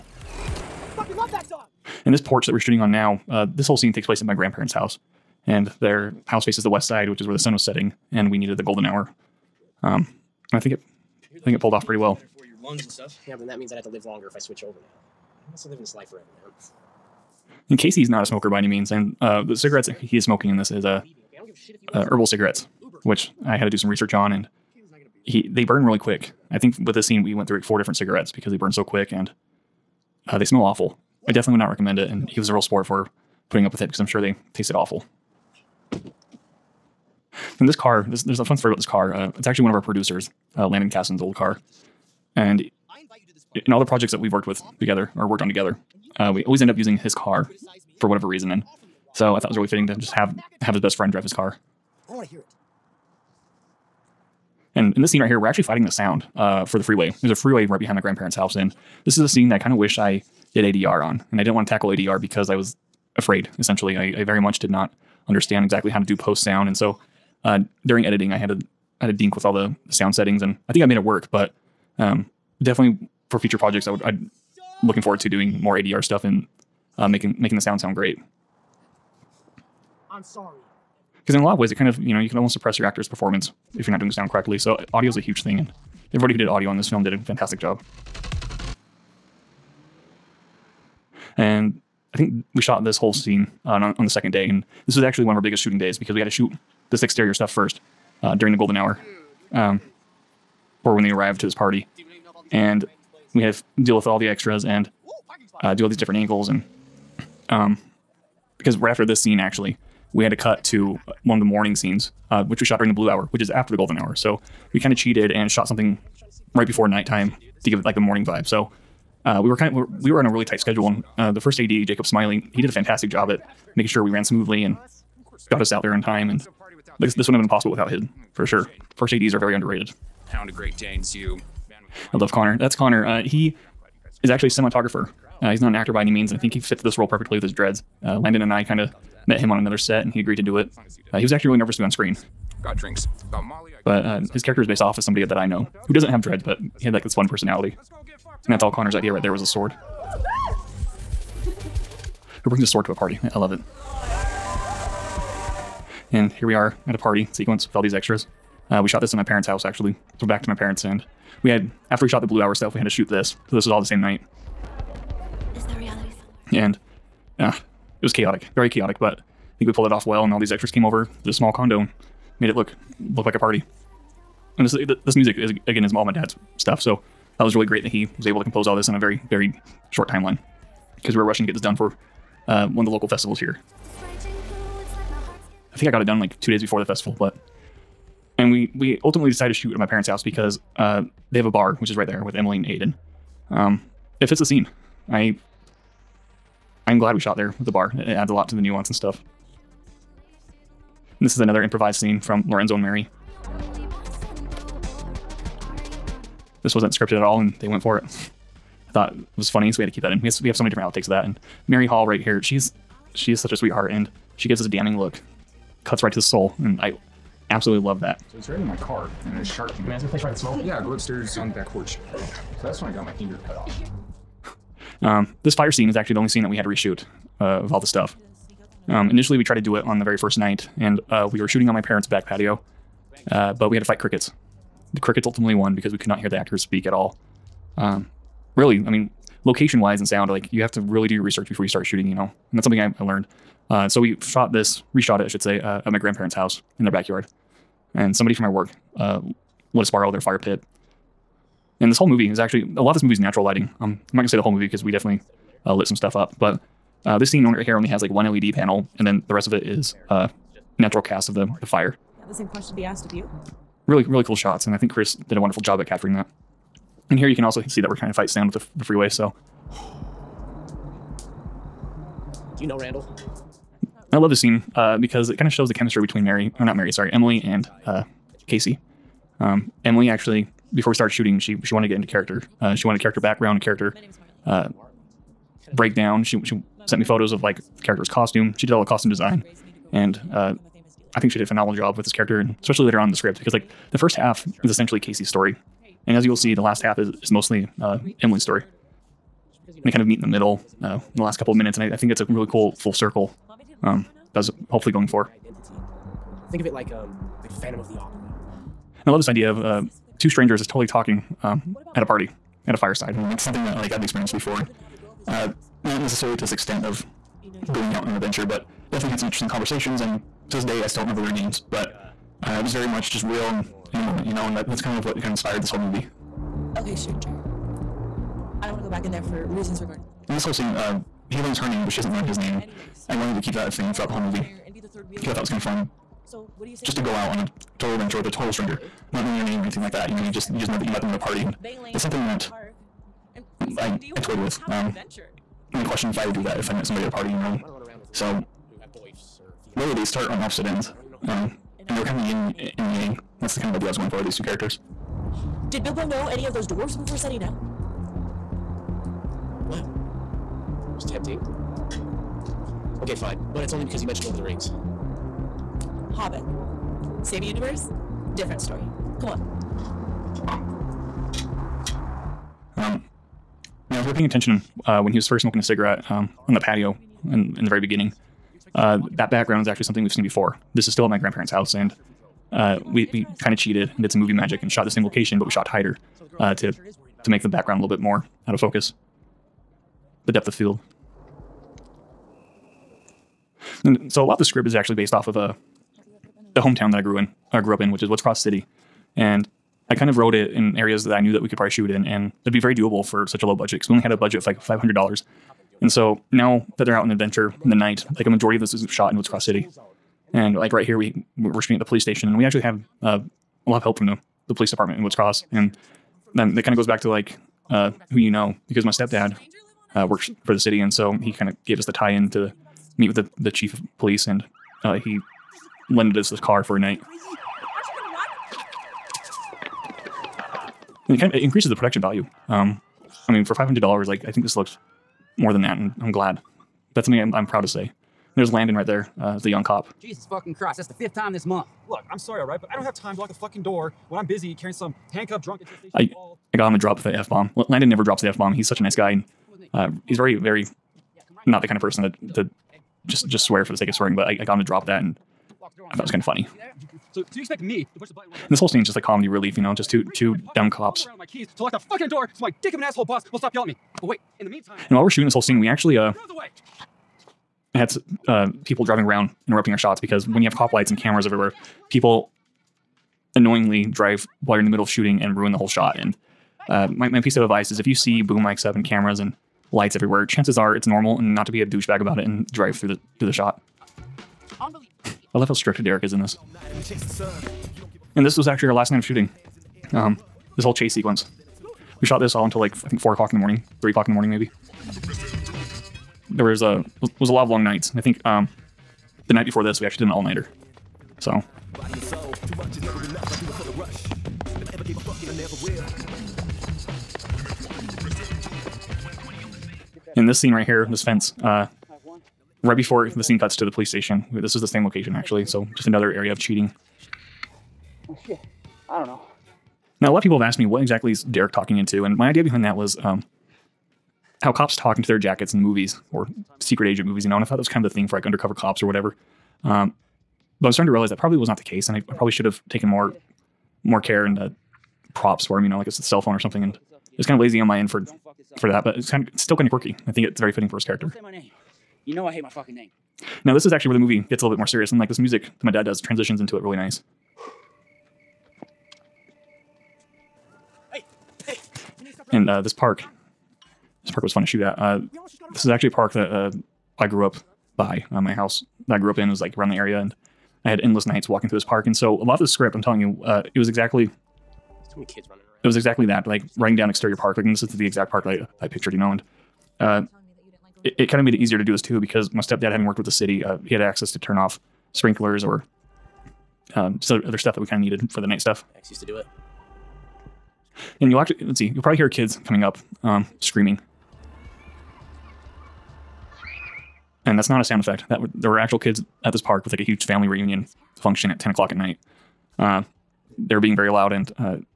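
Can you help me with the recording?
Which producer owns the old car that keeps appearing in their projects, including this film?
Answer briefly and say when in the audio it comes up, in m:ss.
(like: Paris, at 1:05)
Landon Casson, at 0:40.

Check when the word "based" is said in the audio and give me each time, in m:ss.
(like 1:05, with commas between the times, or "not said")
2:24, 6:34.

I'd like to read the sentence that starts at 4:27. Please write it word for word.
And here you can also see that we're kind of fight sound with the, the freeway.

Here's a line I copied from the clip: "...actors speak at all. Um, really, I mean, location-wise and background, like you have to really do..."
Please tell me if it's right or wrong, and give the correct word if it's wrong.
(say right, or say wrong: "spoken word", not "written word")
wrong: "sound", not "background".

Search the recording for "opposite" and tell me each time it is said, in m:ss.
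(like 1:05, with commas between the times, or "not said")
5:50.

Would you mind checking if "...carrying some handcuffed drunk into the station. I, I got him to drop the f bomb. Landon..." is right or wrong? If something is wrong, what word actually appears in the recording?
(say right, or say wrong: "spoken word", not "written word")
right.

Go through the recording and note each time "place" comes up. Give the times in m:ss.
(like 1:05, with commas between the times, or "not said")
0:04, 3:40.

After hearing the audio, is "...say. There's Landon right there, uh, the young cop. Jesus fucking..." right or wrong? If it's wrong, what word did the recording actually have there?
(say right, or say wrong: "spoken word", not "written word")
right.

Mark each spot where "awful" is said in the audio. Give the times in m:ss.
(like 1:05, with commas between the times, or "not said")
0:30, 0:34.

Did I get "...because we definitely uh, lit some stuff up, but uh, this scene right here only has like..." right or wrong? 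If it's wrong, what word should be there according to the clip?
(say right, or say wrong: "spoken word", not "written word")
right.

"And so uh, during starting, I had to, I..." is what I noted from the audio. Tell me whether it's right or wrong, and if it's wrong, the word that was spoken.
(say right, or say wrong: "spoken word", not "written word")
wrong: "editing", not "starting".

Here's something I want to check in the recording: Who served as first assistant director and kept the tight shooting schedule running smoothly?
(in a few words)
Jacob Smiley.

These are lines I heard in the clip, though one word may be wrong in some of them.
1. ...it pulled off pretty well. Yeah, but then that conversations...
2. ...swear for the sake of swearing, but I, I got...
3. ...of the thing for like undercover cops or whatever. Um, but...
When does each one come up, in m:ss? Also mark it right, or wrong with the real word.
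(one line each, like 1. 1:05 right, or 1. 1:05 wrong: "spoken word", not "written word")
1. 0:11 wrong: "means", not "conversations"
2. 7:33 right
3. 8:47 right.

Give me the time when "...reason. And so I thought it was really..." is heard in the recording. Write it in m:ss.
0:48.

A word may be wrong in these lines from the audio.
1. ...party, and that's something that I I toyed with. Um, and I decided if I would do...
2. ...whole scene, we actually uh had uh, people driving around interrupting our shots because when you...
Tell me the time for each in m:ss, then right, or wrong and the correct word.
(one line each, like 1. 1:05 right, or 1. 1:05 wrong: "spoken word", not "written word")
1. 5:41 wrong: "questioned", not "decided"
2. 7:45 right.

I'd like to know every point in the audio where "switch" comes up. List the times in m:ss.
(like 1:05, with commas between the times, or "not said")
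0:14.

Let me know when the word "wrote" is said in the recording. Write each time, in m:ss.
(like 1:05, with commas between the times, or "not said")
6:40.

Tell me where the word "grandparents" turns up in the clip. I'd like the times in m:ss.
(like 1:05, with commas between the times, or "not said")
0:04, 0:57, 4:05, 6:21.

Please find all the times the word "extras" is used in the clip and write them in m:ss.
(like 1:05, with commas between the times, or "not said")
1:44, 2:37, 2:50.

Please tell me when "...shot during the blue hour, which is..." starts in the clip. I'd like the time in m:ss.
1:52.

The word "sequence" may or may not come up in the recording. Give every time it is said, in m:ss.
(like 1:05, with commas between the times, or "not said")
2:37, 8:10.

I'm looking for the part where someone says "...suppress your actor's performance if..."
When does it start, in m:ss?
1:22.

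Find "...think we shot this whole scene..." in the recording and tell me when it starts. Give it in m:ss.
1:32.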